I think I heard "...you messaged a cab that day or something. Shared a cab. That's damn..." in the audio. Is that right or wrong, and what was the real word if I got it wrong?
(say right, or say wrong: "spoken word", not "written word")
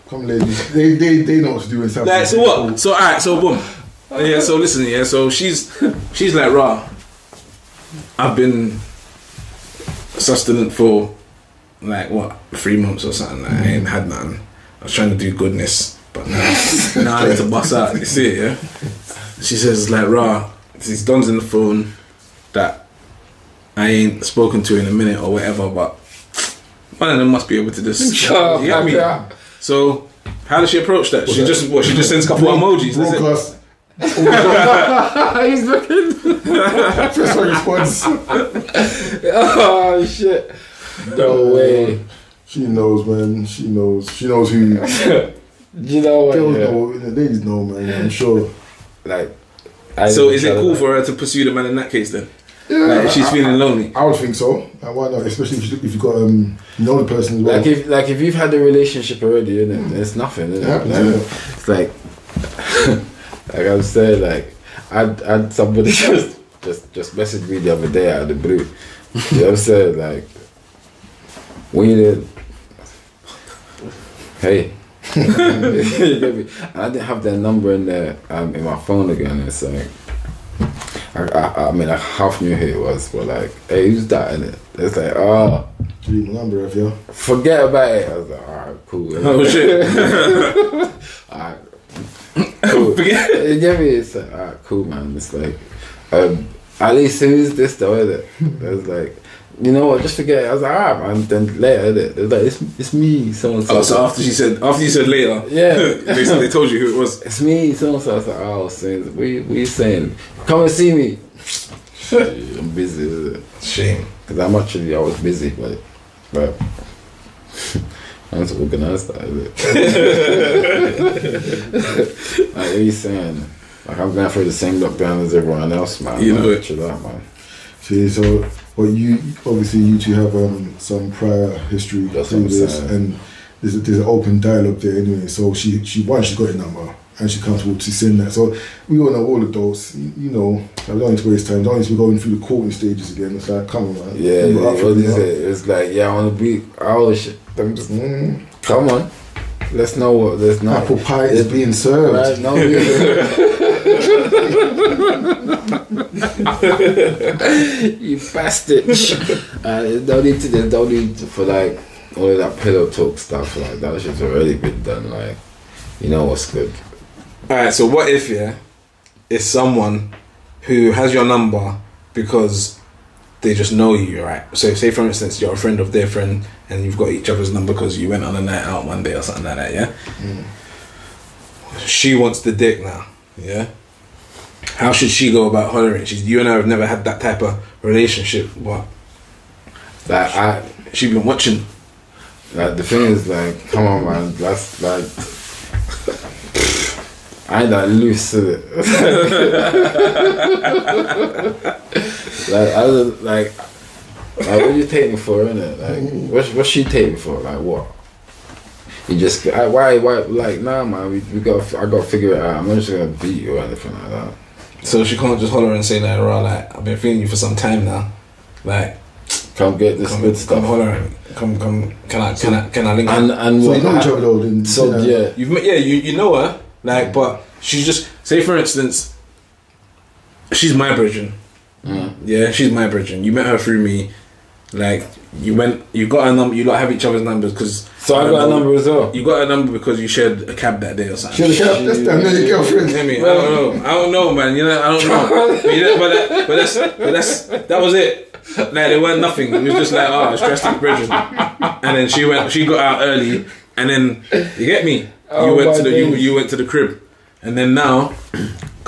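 wrong: "shared", not "messaged".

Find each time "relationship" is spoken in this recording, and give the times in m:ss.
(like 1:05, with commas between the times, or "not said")
0:58, 3:07.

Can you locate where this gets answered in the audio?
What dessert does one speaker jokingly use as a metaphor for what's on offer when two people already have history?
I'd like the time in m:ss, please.
2:30.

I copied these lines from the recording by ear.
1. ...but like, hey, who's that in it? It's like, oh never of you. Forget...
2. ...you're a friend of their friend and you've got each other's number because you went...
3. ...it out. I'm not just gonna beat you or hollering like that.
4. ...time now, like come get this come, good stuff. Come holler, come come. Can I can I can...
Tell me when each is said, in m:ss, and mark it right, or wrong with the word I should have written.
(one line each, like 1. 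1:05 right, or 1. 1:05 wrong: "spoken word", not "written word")
1. 1:23 wrong: "number", not "never"
2. 2:55 right
3. 3:32 wrong: "anything", not "hollering"
4. 3:37 right.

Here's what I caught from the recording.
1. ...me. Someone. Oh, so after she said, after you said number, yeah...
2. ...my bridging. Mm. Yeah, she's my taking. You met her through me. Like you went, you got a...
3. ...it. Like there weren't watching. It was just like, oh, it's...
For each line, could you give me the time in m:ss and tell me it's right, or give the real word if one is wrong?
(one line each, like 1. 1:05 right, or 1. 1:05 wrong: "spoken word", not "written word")
1. 1:42 wrong: "later", not "number"
2. 3:50 wrong: "bridging", not "taking"
3. 4:07 wrong: "nothing", not "watching".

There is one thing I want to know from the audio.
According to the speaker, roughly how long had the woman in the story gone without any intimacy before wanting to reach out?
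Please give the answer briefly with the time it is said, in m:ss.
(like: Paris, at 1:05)
3 months, at 0:12.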